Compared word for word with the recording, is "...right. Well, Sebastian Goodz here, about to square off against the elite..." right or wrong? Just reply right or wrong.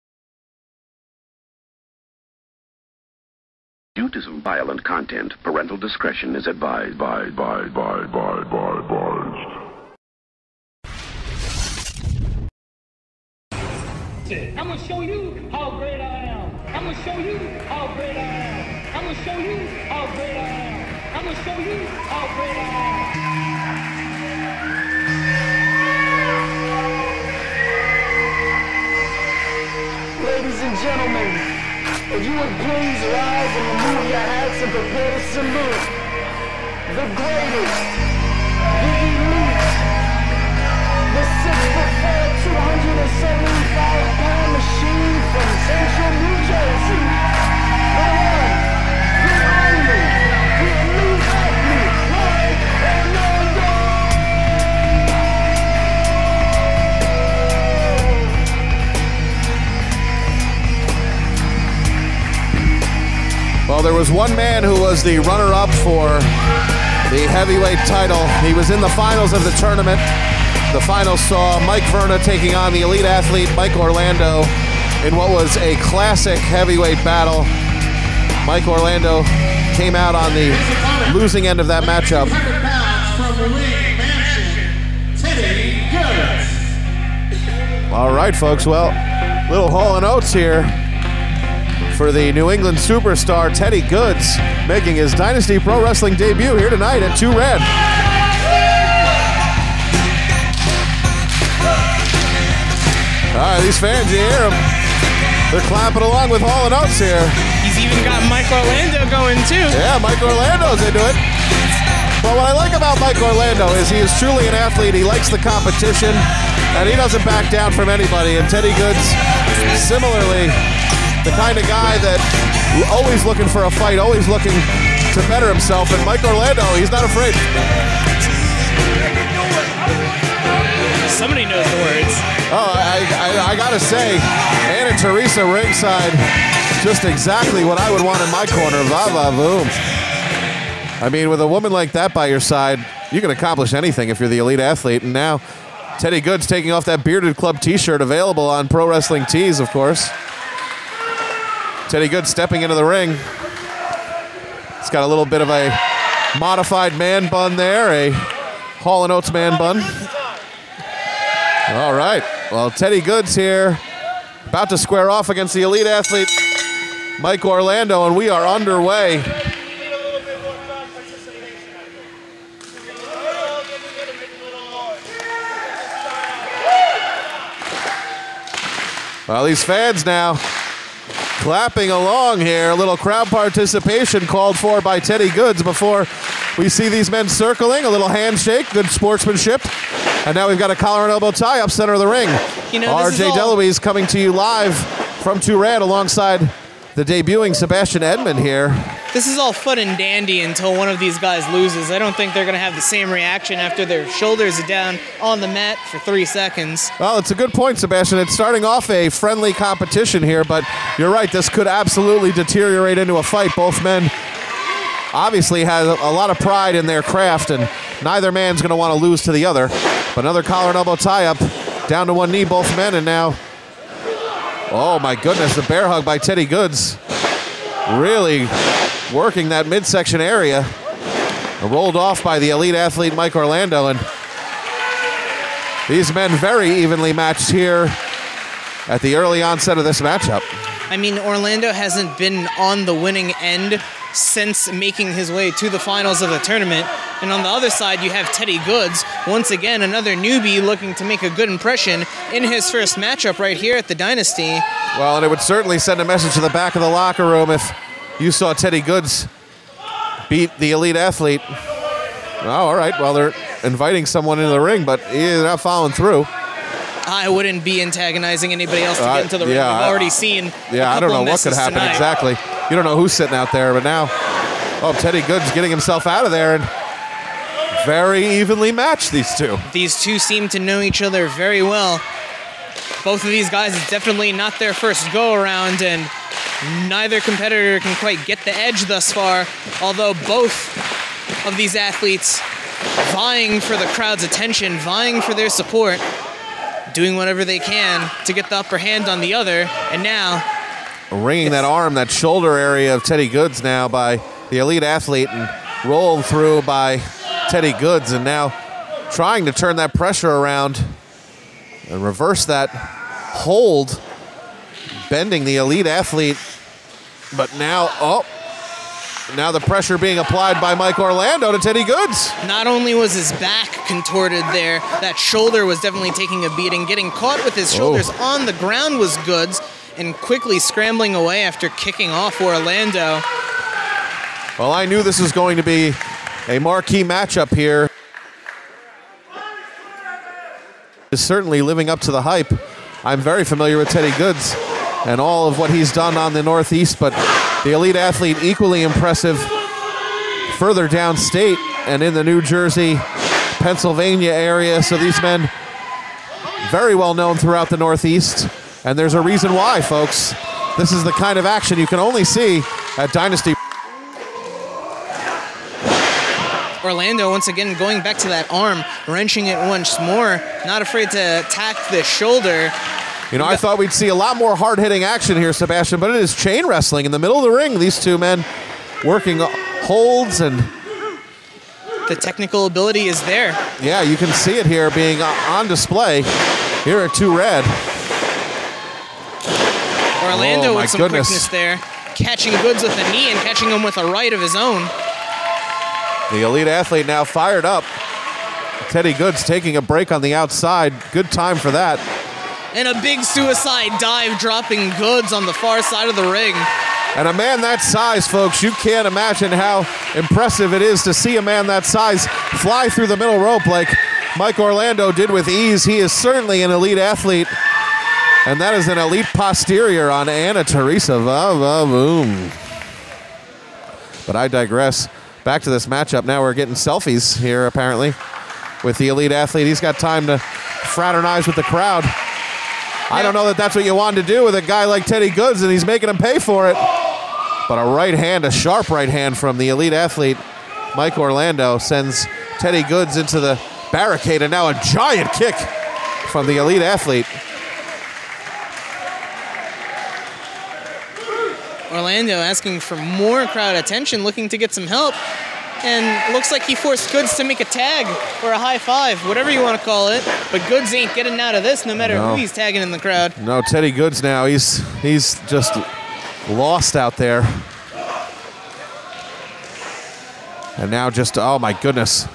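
wrong.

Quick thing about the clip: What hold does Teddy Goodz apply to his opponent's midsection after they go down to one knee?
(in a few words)
Bear hug.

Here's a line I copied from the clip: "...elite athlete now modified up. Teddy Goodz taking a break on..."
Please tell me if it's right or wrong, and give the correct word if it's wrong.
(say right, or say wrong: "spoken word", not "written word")
wrong: "fired", not "modified".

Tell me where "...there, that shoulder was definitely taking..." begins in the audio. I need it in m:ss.
5:24.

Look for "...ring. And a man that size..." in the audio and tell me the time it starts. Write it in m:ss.
6:46.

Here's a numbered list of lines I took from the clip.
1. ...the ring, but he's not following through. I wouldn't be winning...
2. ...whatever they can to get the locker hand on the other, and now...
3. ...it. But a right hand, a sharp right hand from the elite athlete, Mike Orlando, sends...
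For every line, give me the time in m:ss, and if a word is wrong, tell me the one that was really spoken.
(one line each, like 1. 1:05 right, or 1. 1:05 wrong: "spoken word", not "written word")
1. 4:24 wrong: "antagonizing", not "winning"
2. 4:57 wrong: "upper", not "locker"
3. 7:16 right.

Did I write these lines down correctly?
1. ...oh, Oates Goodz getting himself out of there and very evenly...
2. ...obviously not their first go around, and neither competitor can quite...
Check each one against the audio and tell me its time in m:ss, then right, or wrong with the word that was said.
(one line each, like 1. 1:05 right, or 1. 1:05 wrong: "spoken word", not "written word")
1. 4:34 wrong: "Teddy", not "Oates"
2. 4:43 wrong: "definitely", not "obviously".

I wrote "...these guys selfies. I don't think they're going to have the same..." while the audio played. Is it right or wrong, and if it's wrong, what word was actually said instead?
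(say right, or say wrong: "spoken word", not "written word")
wrong: "loses", not "selfies".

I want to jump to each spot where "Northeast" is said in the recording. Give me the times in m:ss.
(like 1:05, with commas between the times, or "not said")
5:46, 5:57.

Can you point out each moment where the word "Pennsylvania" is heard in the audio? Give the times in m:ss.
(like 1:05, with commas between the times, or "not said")
5:53.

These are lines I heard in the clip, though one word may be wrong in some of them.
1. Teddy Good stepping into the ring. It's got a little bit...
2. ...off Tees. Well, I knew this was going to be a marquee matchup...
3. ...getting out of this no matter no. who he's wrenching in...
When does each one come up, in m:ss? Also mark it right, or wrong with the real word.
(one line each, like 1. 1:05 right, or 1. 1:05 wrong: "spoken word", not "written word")
1. 2:31 right
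2. 5:32 wrong: "Orlando", not "Tees"
3. 7:41 wrong: "tagging", not "wrenching".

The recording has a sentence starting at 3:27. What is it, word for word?
Well, it's a good point, Sebastian.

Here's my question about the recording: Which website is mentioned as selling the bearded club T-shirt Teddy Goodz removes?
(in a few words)
Pro Wrestling Tees.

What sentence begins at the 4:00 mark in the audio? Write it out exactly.
I mean, Orlando hasn't been on the winning end since making his way to the finals of the tournament.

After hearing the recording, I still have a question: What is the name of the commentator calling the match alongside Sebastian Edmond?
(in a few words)
RJ Deloise.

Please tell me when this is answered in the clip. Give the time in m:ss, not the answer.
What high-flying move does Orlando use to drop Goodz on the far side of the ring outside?
6:43.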